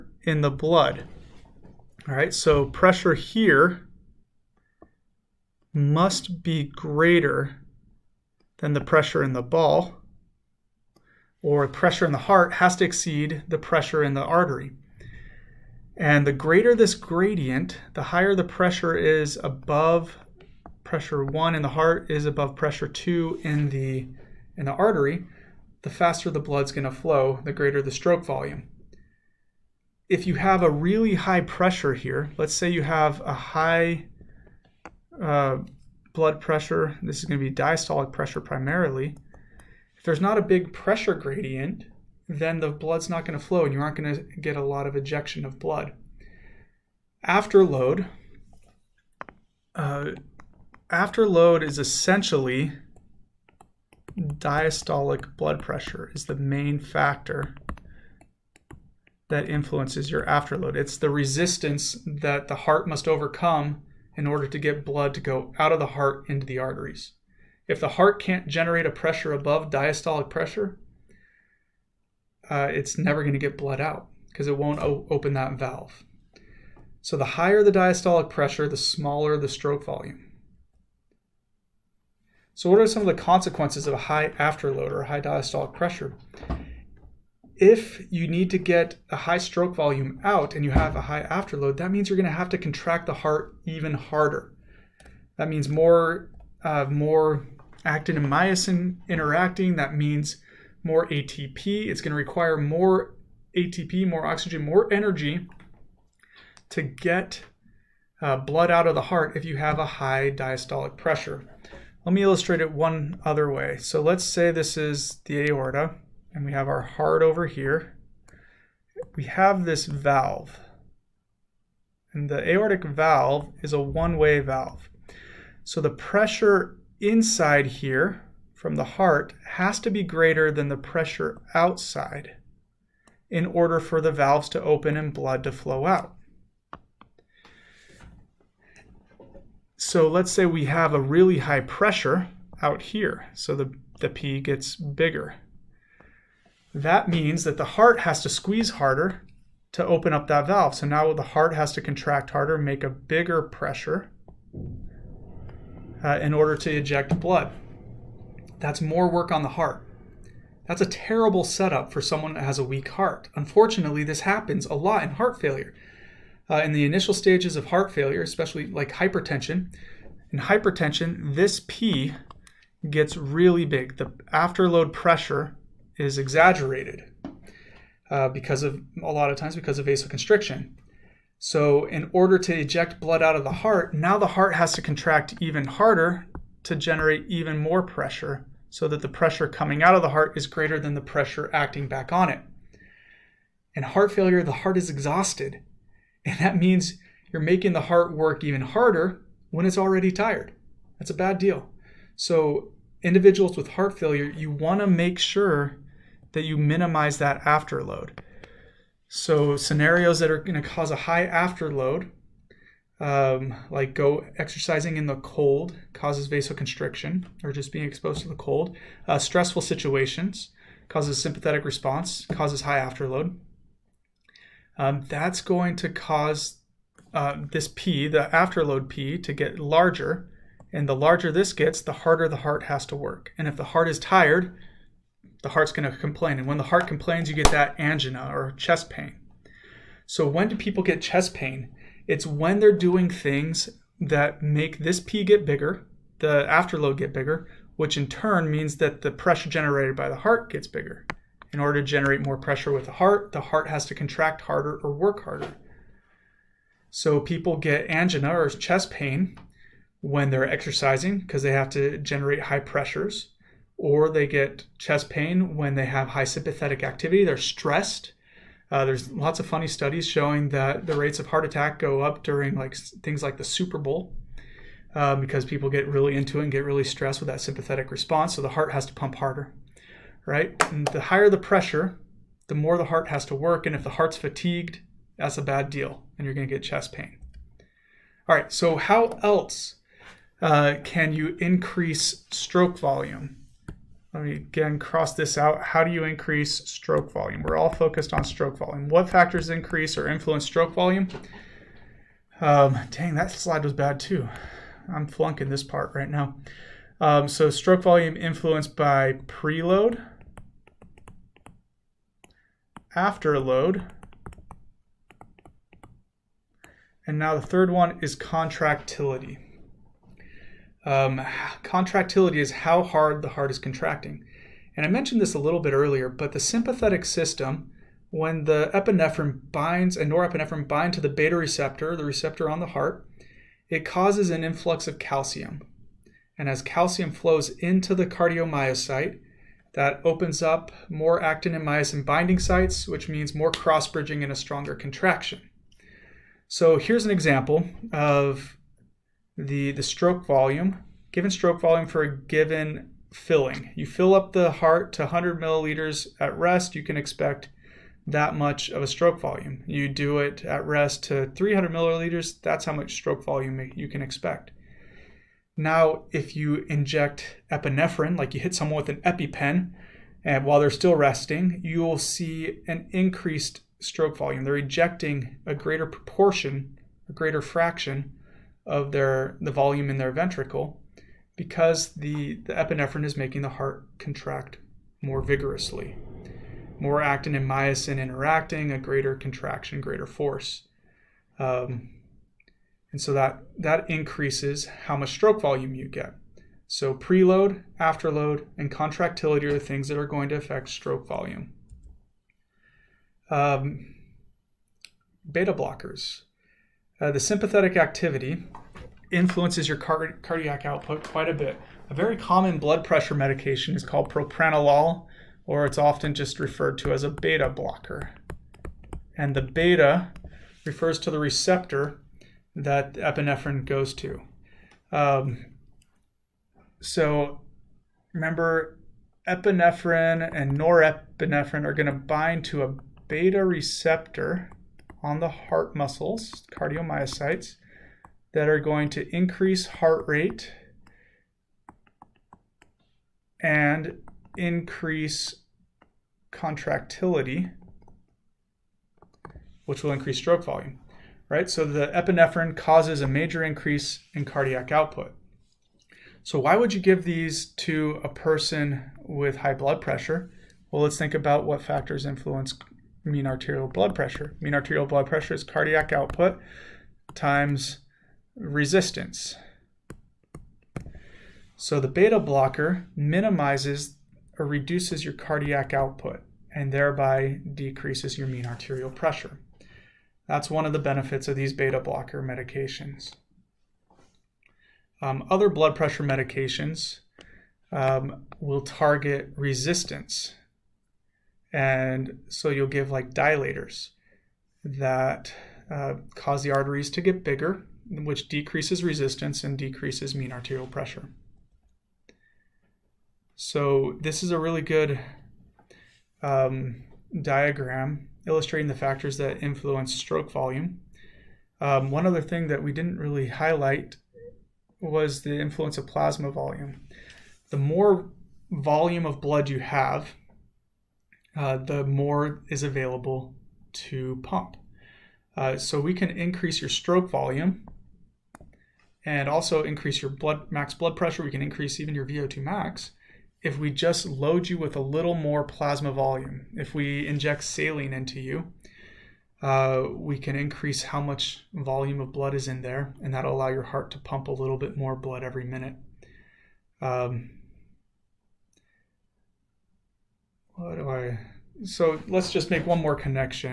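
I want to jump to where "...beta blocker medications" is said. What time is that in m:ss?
8:01.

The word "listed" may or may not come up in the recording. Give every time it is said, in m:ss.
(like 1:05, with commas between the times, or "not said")
not said.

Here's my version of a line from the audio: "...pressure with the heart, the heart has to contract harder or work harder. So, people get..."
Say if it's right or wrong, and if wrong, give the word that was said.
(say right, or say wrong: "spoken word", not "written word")
right.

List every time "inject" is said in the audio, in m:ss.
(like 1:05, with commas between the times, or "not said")
6:06, 8:57.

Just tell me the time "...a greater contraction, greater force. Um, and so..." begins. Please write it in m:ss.
6:28.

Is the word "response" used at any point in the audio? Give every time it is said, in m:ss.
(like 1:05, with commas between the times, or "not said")
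3:41, 4:37.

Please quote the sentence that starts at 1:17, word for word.
So the higher the diastolic pressure, the smaller the stroke volume.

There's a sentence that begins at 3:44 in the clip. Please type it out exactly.
Um, that's going to cause uh, this P, the afterload P, to get larger.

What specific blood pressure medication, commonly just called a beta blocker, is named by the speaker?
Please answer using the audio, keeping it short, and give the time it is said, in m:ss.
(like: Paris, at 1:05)
Propranolol, at 6:54.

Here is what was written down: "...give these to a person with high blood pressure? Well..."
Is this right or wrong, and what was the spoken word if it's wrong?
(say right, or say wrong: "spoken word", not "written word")
right.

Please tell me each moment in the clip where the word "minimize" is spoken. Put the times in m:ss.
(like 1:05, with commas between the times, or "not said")
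3:26, 7:52.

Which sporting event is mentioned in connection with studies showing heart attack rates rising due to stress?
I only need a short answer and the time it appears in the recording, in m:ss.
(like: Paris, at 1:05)
Super Bowl, at 4:33.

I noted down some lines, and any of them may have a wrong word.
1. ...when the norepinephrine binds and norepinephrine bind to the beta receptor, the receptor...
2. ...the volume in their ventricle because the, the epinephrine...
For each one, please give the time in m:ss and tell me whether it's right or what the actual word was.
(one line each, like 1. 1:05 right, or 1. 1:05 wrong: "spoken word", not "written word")
1. 5:28 wrong: "epinephrine", not "norepinephrine"
2. 6:19 right.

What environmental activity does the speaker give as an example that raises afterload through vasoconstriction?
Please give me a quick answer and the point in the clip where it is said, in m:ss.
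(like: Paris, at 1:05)
Exercising in the cold, at 3:34.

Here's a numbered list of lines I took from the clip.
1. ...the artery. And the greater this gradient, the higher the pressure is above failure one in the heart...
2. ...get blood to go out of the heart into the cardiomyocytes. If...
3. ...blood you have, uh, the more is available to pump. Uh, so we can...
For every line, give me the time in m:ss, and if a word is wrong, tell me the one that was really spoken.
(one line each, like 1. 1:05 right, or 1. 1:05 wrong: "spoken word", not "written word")
1. 0:14 wrong: "pressure", not "failure"
2. 1:04 wrong: "arteries", not "cardiomyocytes"
3. 8:39 right.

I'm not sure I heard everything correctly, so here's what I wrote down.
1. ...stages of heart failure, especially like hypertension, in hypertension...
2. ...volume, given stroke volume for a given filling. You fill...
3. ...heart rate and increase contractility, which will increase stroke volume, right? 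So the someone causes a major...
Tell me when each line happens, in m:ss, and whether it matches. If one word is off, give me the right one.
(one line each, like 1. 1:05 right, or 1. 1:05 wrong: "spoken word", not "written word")
1. 2:47 right
2. 5:50 right
3. 7:19 wrong: "epinephrine", not "someone".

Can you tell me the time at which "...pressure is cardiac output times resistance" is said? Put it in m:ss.
7:45.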